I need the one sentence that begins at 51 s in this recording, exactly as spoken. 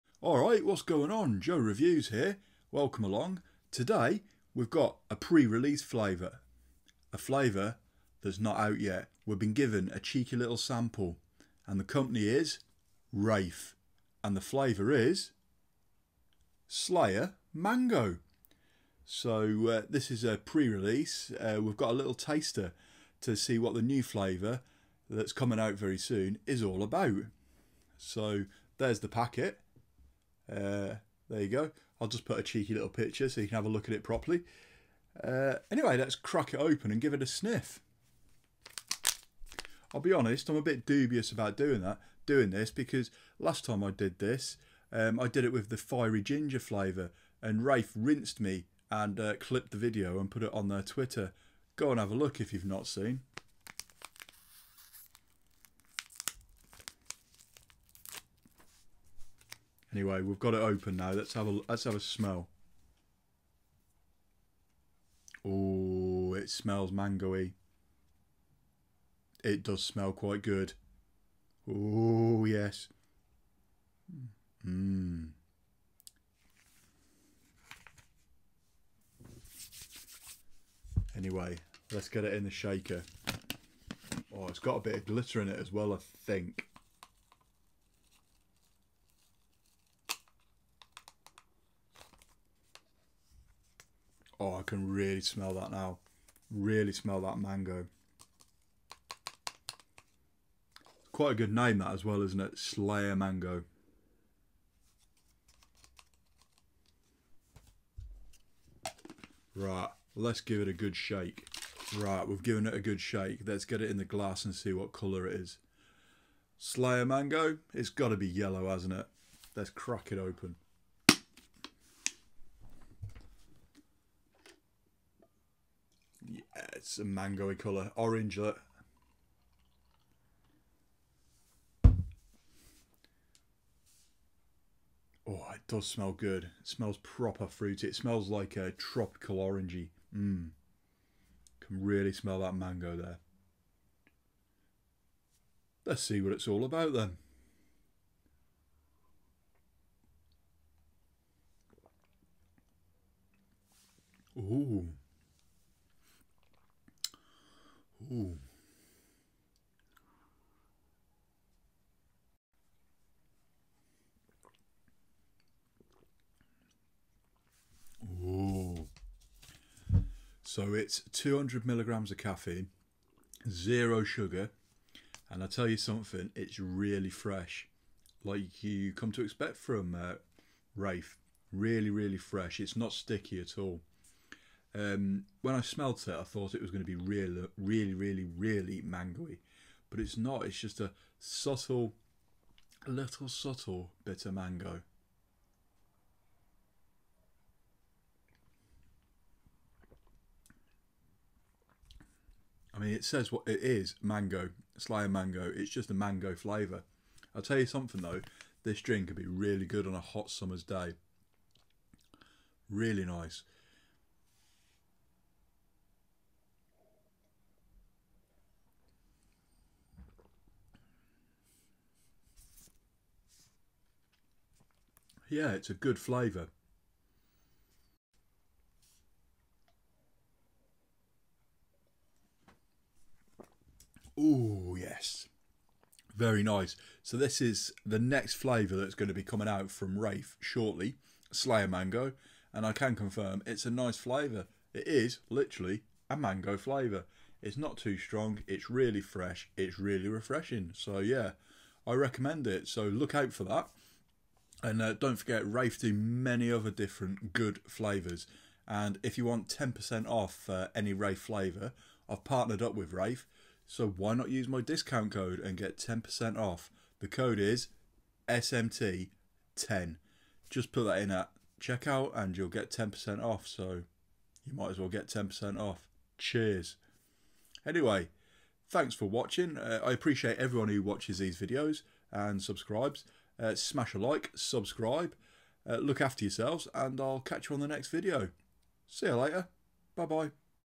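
Go and have a look if you've not seen.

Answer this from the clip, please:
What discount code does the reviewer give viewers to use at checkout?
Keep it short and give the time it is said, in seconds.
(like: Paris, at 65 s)
SMT10, at 268 s.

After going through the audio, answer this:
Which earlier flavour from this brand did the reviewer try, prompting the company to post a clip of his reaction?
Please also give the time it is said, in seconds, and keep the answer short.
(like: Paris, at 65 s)
Fiery ginger, at 45 s.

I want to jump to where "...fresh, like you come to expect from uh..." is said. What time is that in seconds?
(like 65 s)
177 s.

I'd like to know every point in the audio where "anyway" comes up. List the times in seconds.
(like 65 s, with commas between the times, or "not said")
35 s, 59 s, 81 s, 277 s.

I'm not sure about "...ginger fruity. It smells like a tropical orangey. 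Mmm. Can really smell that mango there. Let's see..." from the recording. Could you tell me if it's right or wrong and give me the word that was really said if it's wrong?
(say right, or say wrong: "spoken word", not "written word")
wrong: "proper", not "ginger".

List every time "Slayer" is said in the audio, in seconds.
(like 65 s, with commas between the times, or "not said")
16 s, 102 s, 116 s, 241 s.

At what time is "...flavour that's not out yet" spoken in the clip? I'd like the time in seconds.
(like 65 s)
7 s.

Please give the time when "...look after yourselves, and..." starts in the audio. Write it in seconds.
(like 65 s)
285 s.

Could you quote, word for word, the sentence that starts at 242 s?
And I can confirm it's a nice flavour.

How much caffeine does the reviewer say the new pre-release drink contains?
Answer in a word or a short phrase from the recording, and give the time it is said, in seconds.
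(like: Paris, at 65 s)
200 milligrams, at 171 s.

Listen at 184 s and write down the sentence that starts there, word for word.
Um, when I smelt it, I thought it was going to be really, really, really, really mangoey, but it's not.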